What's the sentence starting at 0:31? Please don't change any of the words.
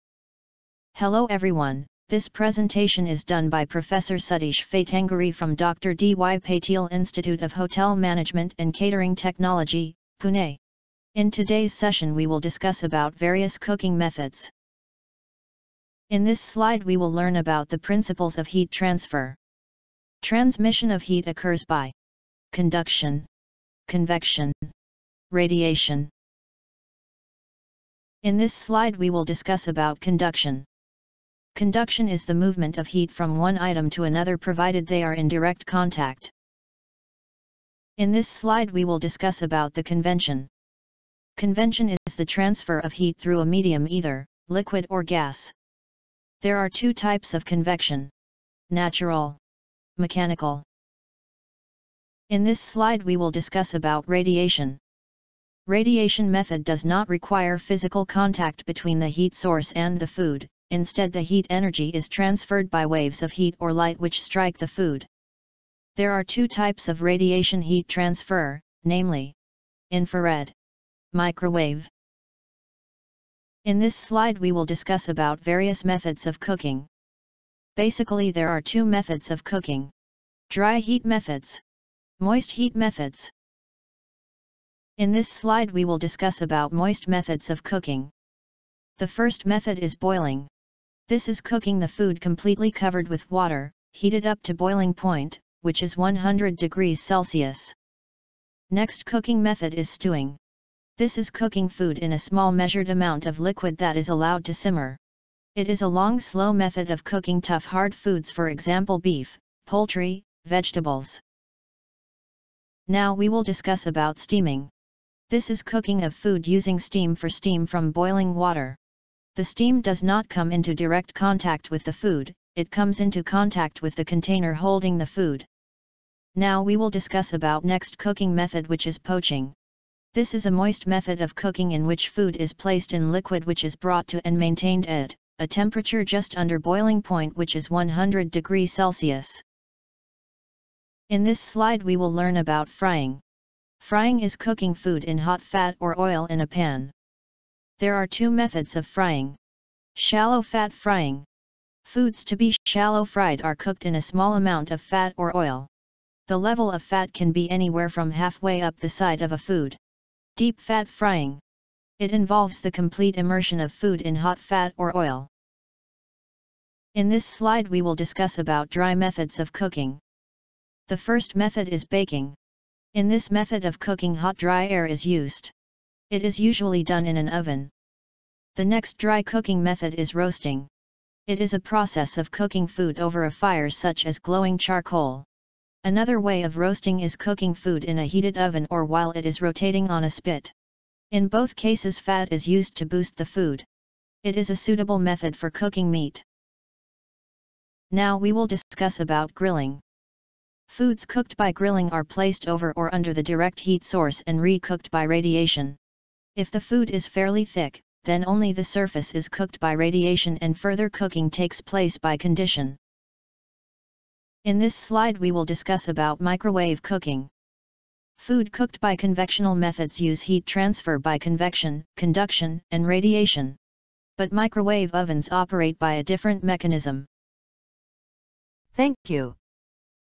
Conduction is the movement of heat from one item to another provided they are in direct contact.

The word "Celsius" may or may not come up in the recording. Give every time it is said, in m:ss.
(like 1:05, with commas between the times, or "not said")
1:37, 2:18.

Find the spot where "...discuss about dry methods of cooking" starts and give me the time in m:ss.
2:47.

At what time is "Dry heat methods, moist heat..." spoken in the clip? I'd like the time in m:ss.
1:20.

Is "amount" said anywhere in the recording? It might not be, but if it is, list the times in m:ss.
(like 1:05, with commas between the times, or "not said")
1:42, 2:34.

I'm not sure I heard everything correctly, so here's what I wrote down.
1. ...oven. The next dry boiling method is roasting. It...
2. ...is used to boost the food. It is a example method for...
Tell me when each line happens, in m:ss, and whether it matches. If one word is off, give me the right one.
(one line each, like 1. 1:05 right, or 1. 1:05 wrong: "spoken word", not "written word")
1. 2:57 wrong: "cooking", not "boiling"
2. 3:12 wrong: "suitable", not "example".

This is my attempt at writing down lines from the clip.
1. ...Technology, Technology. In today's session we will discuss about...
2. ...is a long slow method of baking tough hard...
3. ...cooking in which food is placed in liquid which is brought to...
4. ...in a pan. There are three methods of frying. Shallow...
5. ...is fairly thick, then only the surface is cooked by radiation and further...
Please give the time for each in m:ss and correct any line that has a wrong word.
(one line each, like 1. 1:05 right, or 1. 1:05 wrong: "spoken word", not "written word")
1. 0:09 wrong: "Pune", not "Technology"
2. 1:45 wrong: "cooking", not "baking"
3. 2:11 right
4. 2:26 wrong: "two", not "three"
5. 3:26 right.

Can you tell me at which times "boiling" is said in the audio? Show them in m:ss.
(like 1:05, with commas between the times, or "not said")
1:29, 1:34, 1:57, 2:16.